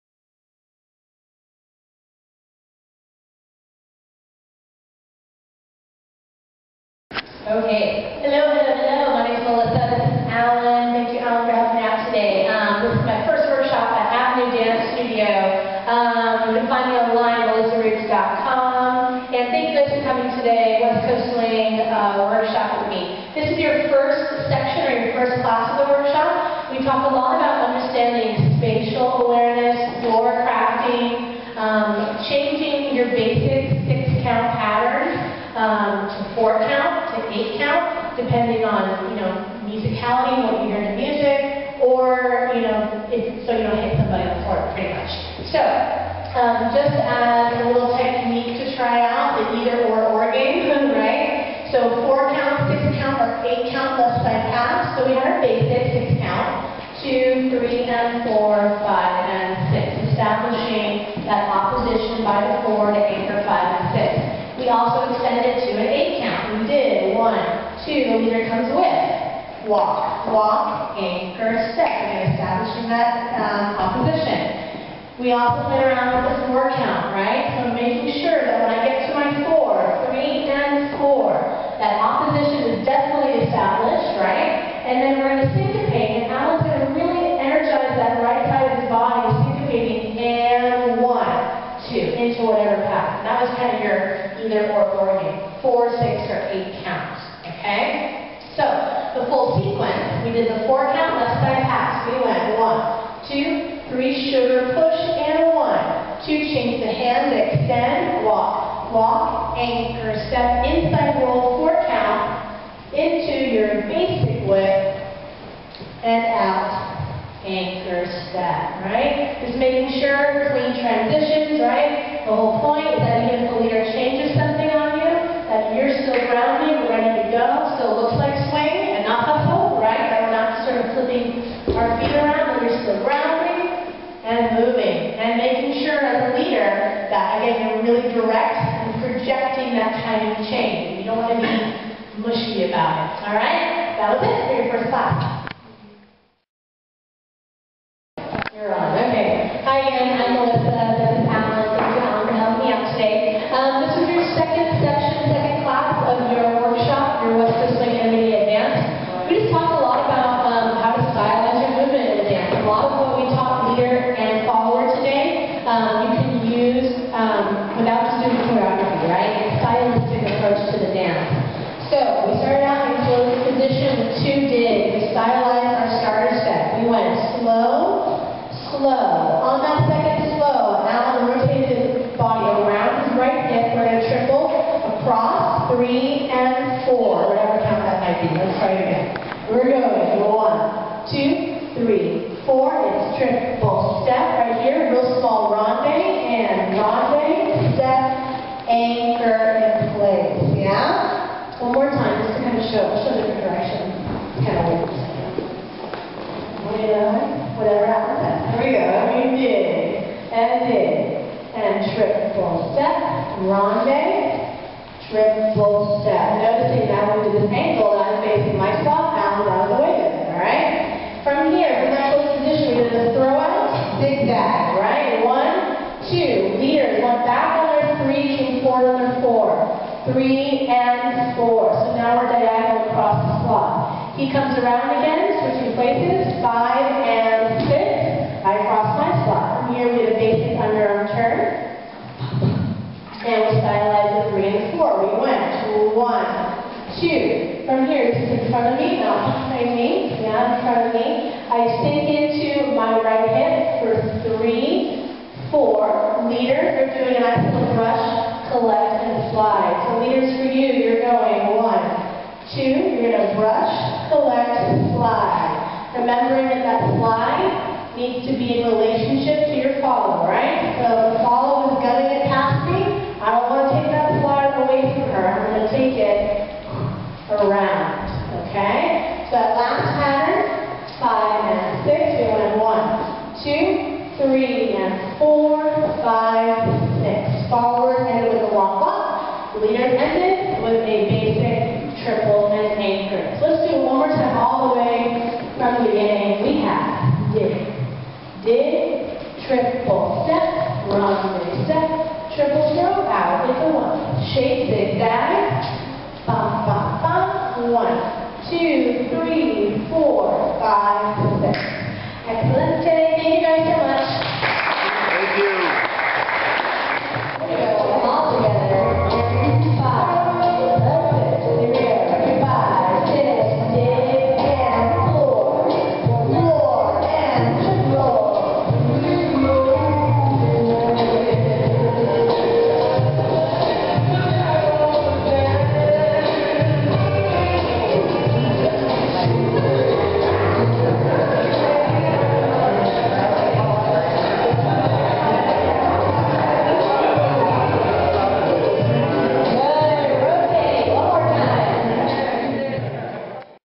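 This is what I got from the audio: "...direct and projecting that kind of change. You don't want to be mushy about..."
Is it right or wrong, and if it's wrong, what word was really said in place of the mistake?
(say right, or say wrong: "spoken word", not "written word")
right.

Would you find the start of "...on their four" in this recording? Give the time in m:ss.
3:48.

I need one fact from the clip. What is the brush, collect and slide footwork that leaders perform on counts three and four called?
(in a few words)
axial brush.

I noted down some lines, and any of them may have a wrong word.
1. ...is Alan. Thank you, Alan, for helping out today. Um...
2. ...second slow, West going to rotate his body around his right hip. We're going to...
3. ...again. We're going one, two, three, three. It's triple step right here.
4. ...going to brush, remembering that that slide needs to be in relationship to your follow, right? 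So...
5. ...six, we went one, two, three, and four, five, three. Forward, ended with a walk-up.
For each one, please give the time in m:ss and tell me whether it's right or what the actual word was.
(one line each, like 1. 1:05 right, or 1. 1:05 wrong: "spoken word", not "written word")
1. 0:10 right
2. 2:59 wrong: "Now", not "West"
3. 3:08 wrong: "four", not "three"
4. 4:23 right
5. 4:41 wrong: "six", not "three".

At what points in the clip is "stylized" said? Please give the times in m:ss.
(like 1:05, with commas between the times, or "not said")
2:55, 4:03.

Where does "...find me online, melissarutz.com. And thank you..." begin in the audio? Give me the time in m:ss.
0:16.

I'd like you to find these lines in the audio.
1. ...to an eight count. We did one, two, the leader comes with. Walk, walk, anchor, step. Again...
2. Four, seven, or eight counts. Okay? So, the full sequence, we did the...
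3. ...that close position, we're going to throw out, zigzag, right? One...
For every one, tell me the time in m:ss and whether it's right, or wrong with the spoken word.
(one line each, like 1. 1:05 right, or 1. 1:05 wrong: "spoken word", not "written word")
1. 1:05 right
2. 1:35 wrong: "six", not "seven"
3. 3:41 right.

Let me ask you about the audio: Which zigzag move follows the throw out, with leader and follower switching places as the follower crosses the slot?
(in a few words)
basic underarm turn.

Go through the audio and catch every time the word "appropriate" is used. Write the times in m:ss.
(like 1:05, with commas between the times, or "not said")
not said.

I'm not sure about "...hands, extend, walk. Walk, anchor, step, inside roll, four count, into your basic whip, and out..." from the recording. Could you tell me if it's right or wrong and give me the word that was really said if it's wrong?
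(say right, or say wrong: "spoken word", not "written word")
right.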